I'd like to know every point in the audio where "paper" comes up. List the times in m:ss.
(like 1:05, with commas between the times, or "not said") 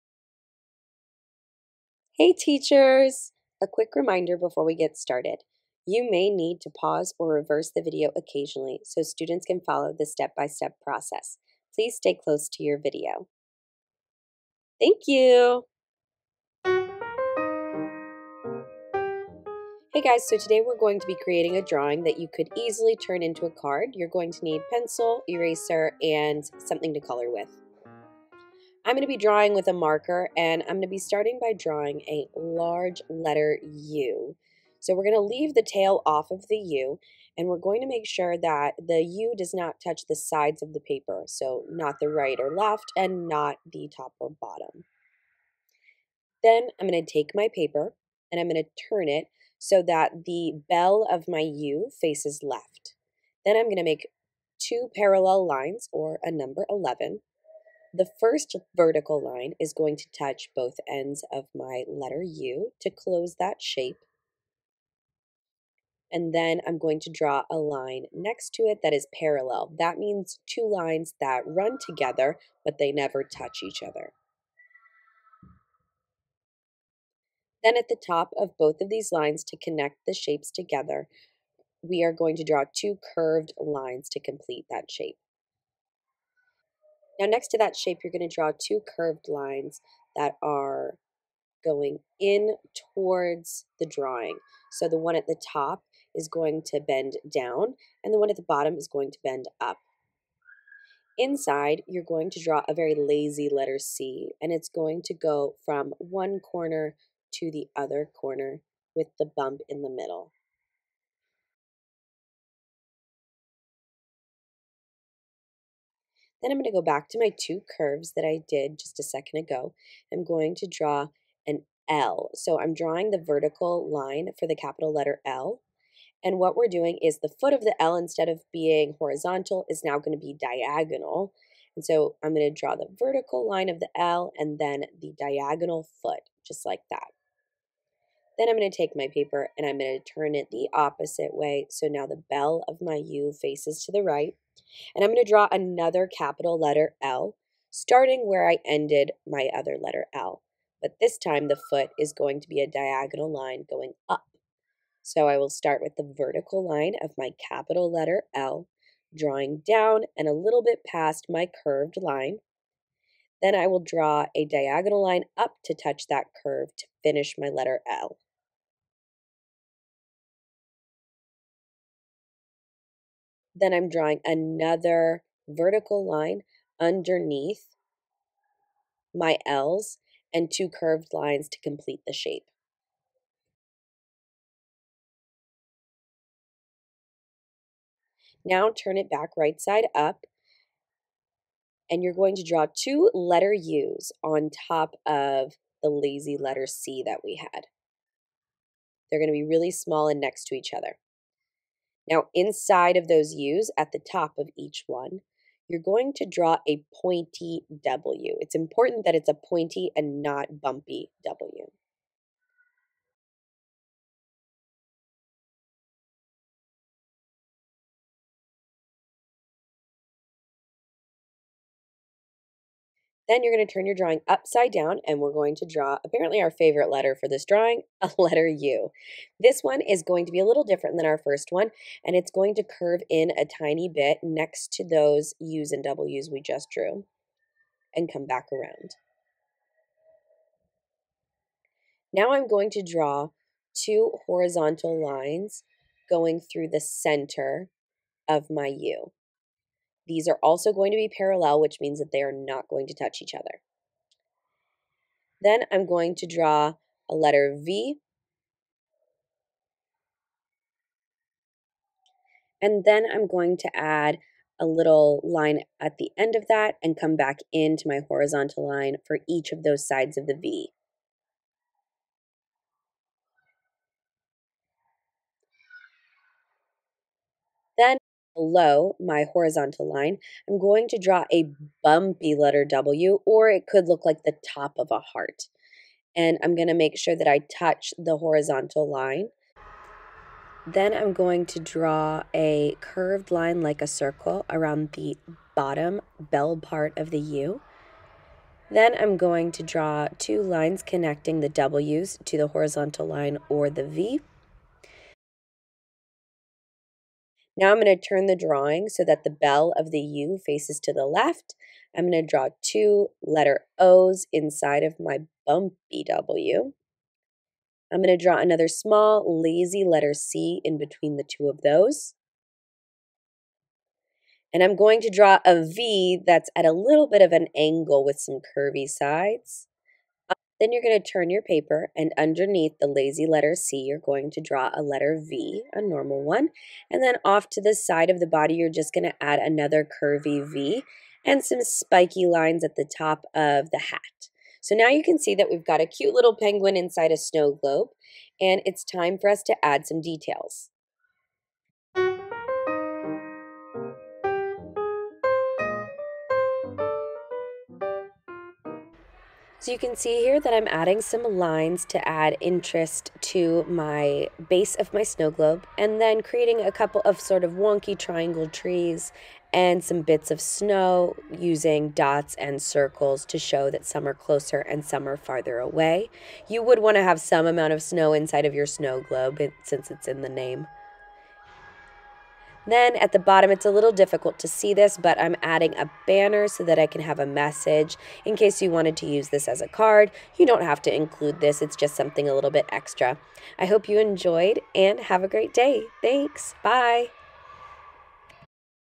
0:40, 0:47, 2:19, 5:31.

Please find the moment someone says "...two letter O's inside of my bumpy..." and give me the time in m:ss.
5:12.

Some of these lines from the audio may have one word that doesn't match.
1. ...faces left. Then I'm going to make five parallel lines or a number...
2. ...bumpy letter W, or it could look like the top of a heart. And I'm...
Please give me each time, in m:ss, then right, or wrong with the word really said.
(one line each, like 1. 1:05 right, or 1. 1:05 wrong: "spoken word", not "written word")
1. 0:52 wrong: "two", not "five"
2. 4:41 right.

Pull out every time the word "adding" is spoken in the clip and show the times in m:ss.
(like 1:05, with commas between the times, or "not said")
6:00, 6:25.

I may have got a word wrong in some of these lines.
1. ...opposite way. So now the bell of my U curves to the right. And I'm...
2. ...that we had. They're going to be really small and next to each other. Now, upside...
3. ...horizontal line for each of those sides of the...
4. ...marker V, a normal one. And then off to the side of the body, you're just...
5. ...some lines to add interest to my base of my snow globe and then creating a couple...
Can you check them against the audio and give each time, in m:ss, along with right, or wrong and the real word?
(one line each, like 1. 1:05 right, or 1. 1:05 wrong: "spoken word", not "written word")
1. 2:20 wrong: "faces", not "curves"
2. 3:17 wrong: "inside", not "upside"
3. 4:28 right
4. 5:34 wrong: "letter", not "marker"
5. 6:01 right.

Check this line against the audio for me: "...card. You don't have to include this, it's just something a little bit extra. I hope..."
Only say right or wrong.
right.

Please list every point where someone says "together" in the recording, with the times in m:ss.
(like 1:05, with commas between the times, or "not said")
1:11, 1:20.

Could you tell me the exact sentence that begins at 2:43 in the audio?
Then I will draw a diagonal line up to touch that curve to finish my letter L.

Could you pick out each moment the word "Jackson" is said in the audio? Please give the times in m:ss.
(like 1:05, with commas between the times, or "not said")
not said.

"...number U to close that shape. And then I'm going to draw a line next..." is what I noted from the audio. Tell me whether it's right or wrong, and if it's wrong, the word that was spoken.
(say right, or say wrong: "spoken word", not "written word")
wrong: "letter", not "number".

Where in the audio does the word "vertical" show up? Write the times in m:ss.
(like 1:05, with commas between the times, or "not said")
0:58, 2:03, 2:12, 2:36, 2:55.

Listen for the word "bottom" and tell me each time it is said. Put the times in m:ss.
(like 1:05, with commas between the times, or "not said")
0:44, 1:38, 4:55, 6:23.